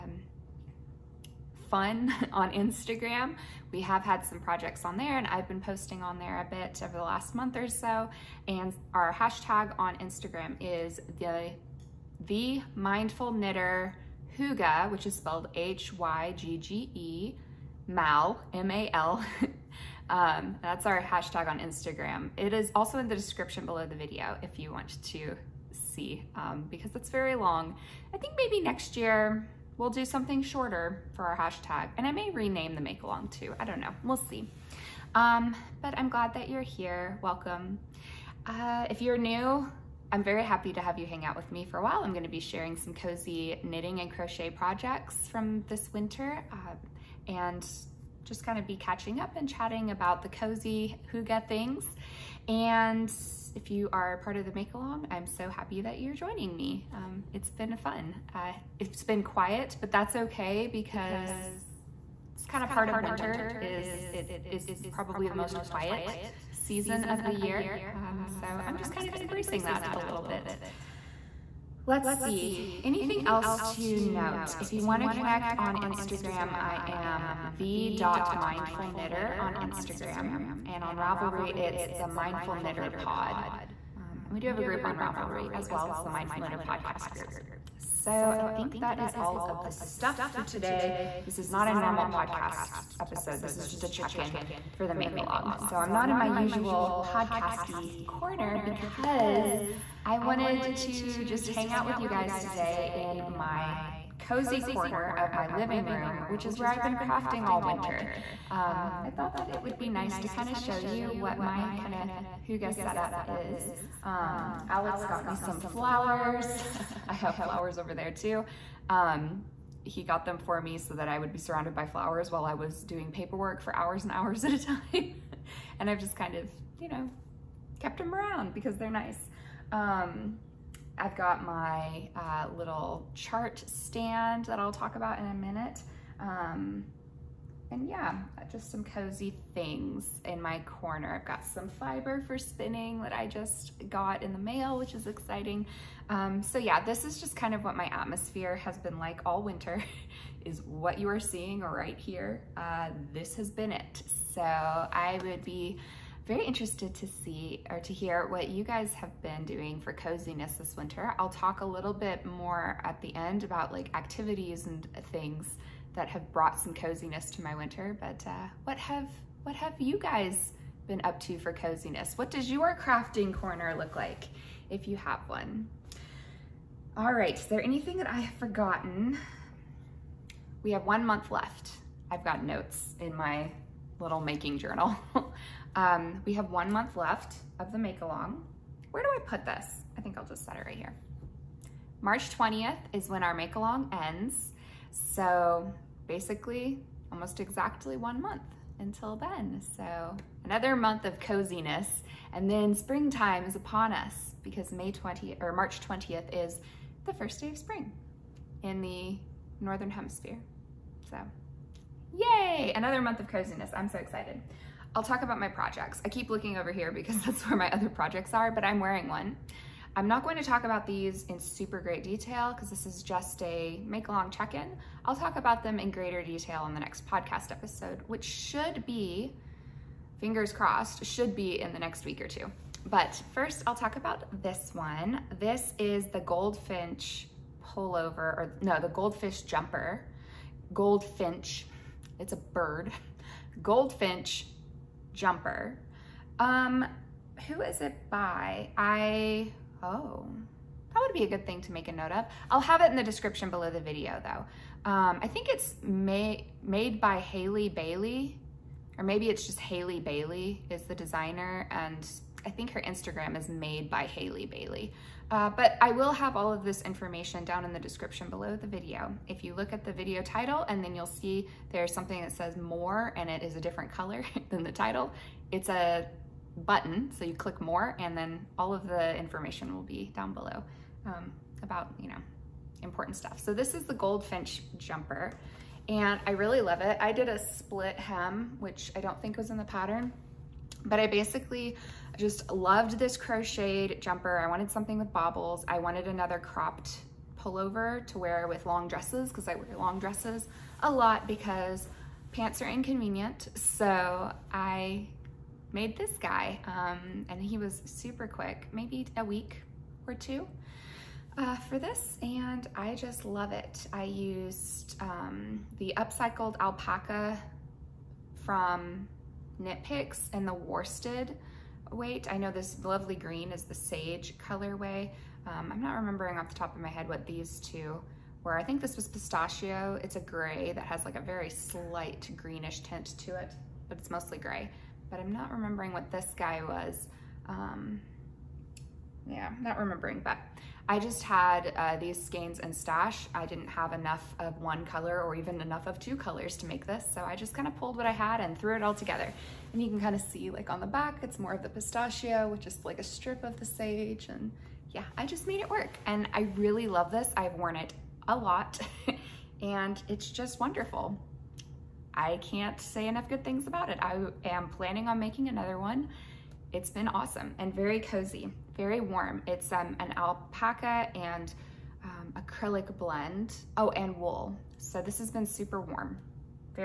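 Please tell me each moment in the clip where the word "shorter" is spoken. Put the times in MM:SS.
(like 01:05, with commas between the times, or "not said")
00:30.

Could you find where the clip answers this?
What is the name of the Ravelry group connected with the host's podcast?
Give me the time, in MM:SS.
01:26.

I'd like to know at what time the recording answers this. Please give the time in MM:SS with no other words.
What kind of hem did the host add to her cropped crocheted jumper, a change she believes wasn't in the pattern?
04:47.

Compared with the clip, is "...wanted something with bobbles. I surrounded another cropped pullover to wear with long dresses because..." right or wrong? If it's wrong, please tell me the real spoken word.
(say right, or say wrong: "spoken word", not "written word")
wrong: "wanted", not "surrounded".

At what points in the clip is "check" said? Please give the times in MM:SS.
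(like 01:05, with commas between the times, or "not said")
01:33, 03:44.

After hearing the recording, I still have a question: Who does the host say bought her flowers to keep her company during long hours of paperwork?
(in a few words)
Alex.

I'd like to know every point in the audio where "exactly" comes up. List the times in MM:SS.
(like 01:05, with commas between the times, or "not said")
03:17.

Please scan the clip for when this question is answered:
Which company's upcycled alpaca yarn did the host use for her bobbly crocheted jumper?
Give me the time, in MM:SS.
05:19.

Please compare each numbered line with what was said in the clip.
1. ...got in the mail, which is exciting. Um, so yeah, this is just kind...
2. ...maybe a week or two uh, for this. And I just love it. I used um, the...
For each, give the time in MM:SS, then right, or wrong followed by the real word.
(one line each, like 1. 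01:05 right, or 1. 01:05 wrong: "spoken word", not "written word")
1. 02:23 right
2. 05:08 right.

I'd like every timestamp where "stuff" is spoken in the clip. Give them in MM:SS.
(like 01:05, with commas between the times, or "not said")
01:29, 04:43.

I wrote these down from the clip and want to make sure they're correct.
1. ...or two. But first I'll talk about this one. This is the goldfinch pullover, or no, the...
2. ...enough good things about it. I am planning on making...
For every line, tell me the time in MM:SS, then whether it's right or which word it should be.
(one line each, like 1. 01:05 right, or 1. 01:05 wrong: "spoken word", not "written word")
1. 03:52 right
2. 06:03 right.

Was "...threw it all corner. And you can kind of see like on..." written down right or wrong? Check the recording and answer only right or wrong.
wrong.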